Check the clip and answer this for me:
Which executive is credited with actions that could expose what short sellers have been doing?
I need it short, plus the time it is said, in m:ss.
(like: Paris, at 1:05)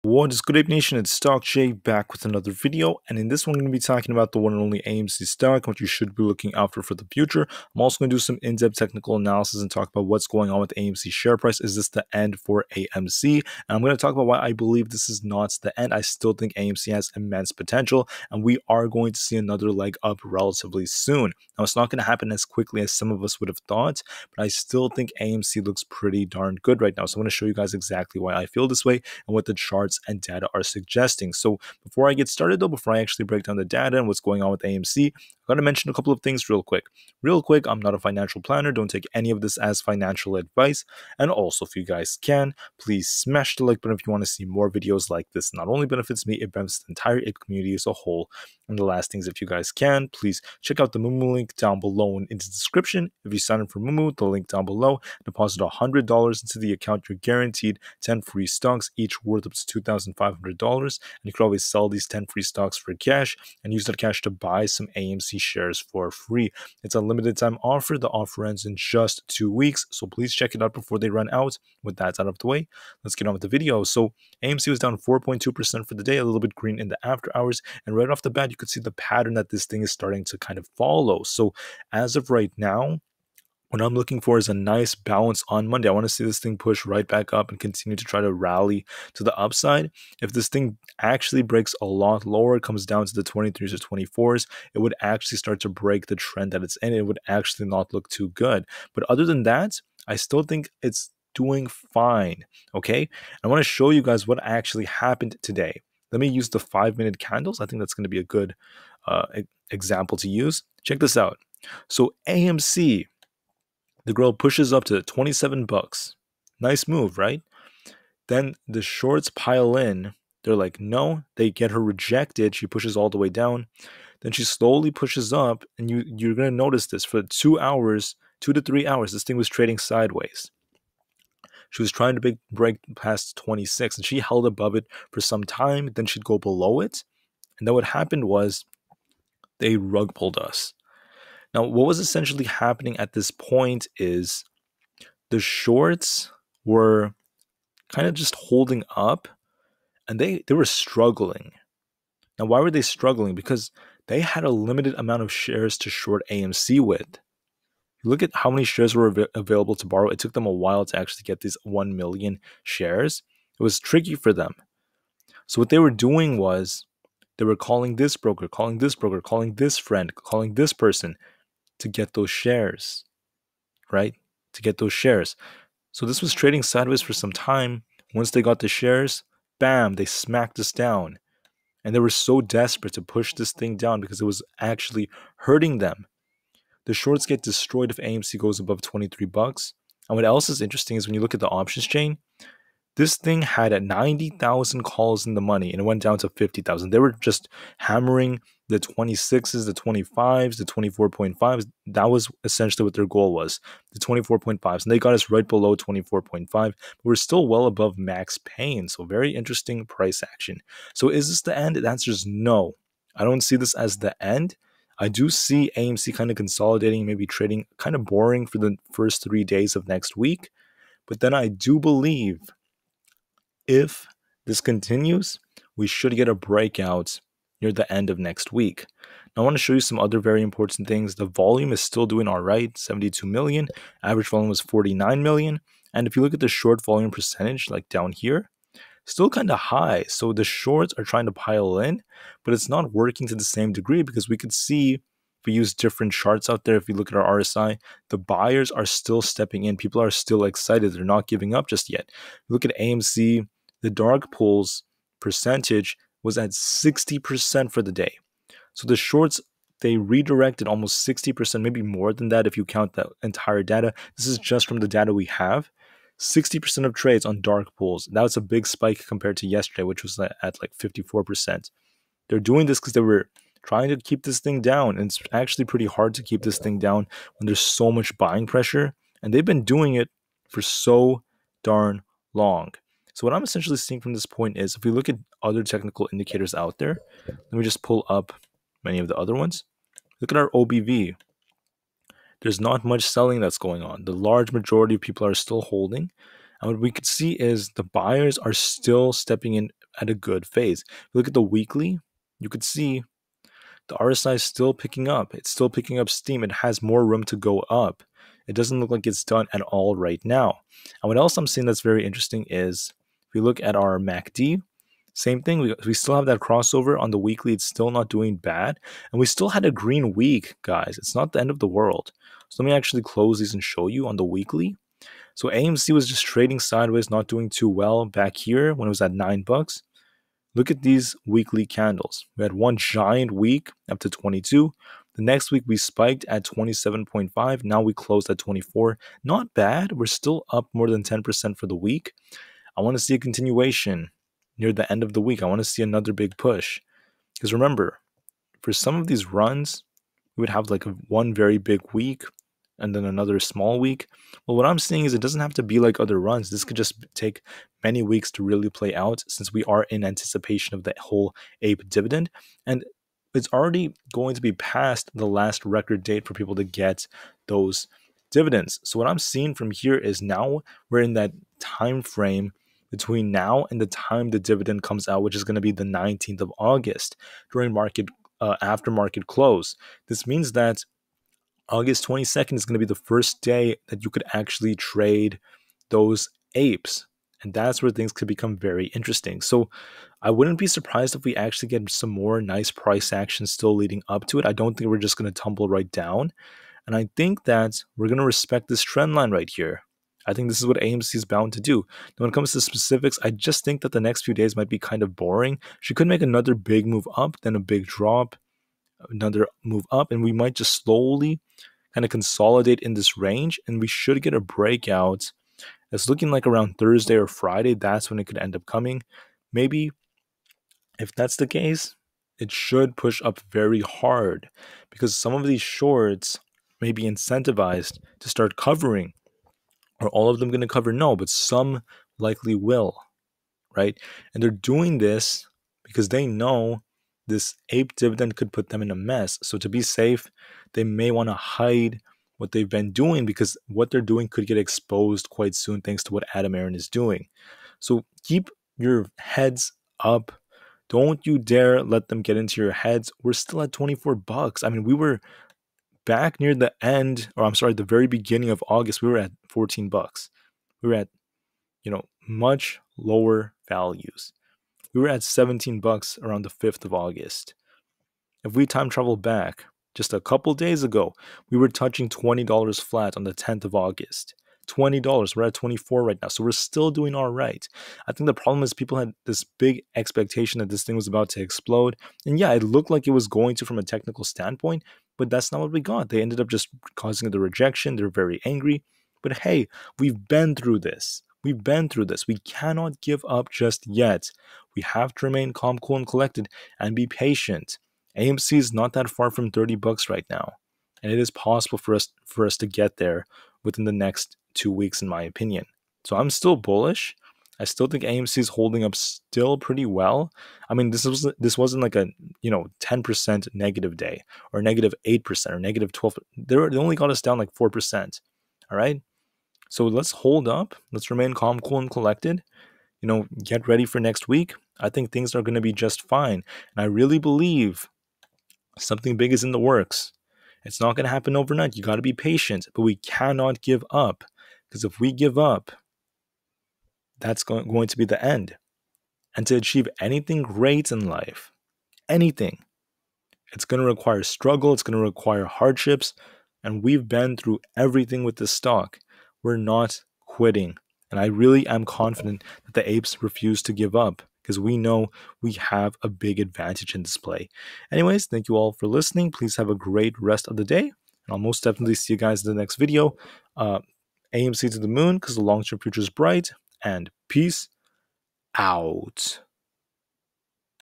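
Adam Aron, at 7:26.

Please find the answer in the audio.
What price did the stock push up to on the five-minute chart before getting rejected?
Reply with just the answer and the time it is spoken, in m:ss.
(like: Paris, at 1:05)
$27, at 1:55.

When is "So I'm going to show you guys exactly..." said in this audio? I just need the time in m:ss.
0:27.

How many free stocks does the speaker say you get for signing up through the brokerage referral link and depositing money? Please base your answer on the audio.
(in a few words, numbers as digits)
10.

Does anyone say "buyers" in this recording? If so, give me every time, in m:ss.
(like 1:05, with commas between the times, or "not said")
4:08, 4:57.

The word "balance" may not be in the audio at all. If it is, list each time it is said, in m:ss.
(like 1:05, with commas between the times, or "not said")
1:24.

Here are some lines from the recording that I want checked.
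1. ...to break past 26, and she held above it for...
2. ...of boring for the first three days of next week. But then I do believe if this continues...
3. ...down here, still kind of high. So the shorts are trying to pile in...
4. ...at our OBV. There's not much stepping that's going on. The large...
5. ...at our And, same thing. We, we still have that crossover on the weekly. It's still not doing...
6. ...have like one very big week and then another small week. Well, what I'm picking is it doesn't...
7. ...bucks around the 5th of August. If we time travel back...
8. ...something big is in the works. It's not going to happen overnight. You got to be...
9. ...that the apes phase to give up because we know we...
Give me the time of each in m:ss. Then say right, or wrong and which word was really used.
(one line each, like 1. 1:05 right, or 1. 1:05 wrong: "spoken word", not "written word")
1. 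2:12 right
2. 3:37 right
3. 3:57 right
4. 4:50 wrong: "selling", not "stepping"
5. 5:13 wrong: "MACD", not "And"
6. 5:50 wrong: "seeing", not "picking"
7. 7:45 right
8. 8:48 right
9. 9:12 wrong: "refuse", not "phase".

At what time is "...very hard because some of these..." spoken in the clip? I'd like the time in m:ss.
7:03.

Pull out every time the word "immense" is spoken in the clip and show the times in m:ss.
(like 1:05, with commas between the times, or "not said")
0:17.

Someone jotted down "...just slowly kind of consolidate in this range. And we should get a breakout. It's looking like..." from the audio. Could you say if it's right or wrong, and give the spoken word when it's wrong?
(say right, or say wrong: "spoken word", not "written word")
right.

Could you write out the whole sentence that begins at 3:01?
And they were so desperate to push this thing down because it was actually hurting them.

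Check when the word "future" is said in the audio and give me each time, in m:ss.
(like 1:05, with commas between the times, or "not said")
0:07, 9:25.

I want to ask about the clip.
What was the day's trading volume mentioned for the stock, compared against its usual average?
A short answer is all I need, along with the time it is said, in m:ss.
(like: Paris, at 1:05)
72 million, at 3:52.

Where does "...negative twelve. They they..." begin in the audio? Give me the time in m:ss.
8:35.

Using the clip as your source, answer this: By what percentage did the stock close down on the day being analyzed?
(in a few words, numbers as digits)
4.2%.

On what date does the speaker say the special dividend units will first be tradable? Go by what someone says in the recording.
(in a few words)
August 22.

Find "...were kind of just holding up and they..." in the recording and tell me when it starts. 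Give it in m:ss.
2:26.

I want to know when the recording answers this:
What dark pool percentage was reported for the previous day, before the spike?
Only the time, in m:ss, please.
4:30.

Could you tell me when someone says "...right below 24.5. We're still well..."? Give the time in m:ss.
3:25.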